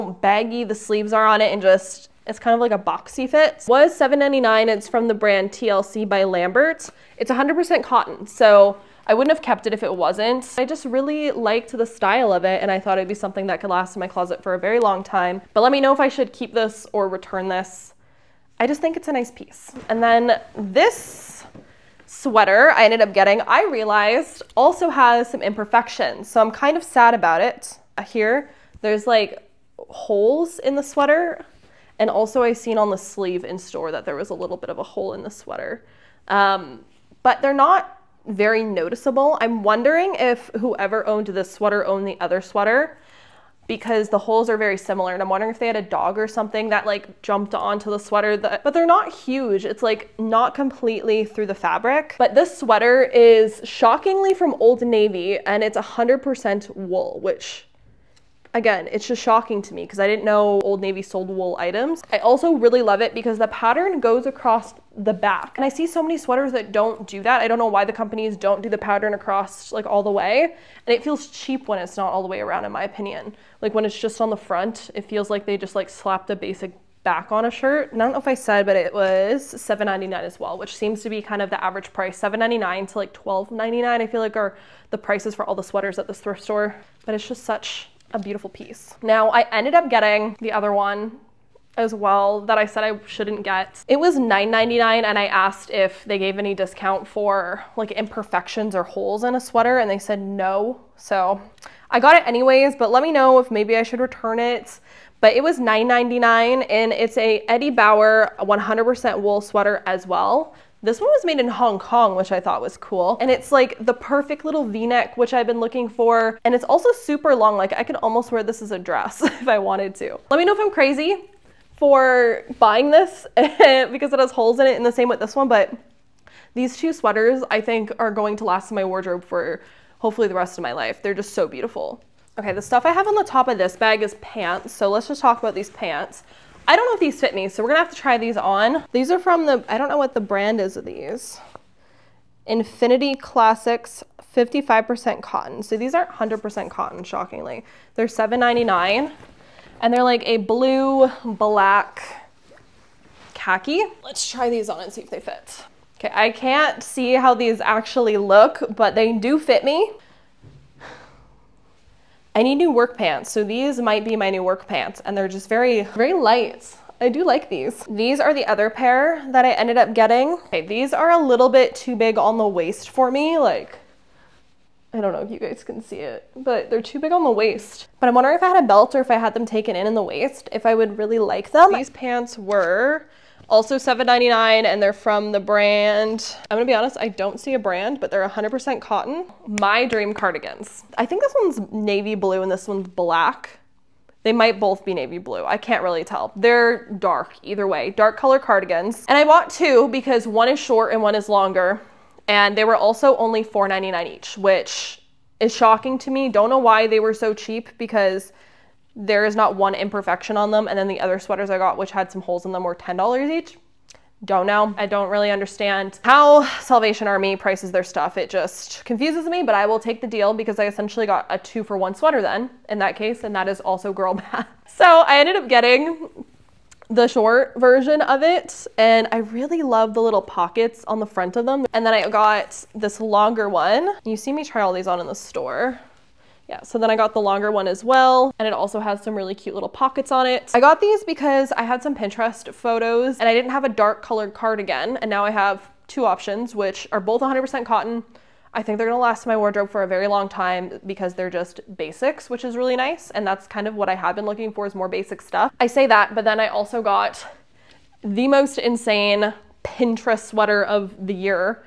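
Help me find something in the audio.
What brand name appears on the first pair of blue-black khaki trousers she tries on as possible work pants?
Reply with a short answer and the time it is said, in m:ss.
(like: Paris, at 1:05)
Infinity Classics, at 2:22.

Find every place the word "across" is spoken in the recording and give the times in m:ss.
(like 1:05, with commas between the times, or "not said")
1:04, 1:09.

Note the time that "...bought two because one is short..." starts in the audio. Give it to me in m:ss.
3:19.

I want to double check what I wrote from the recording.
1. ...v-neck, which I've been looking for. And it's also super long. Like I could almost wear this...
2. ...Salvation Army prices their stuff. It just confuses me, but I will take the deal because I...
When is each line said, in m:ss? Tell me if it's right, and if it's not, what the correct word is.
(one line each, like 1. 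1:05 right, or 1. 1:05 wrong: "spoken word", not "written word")
1. 1:54 right
2. 3:36 right.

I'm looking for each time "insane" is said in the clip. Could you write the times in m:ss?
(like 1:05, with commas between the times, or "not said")
4:18.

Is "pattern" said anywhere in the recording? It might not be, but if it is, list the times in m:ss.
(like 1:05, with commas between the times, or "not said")
1:03, 1:08.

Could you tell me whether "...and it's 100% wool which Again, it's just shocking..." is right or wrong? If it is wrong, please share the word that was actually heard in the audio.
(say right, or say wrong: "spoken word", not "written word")
right.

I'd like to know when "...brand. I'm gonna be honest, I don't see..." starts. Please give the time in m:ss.
3:05.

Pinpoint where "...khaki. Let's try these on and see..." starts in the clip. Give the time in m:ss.
2:33.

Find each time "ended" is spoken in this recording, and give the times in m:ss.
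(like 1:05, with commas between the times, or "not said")
0:22, 1:29, 2:49, 3:45.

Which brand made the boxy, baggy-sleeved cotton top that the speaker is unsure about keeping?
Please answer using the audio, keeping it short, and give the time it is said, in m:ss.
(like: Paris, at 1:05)
TLC by Lambert, at 0:05.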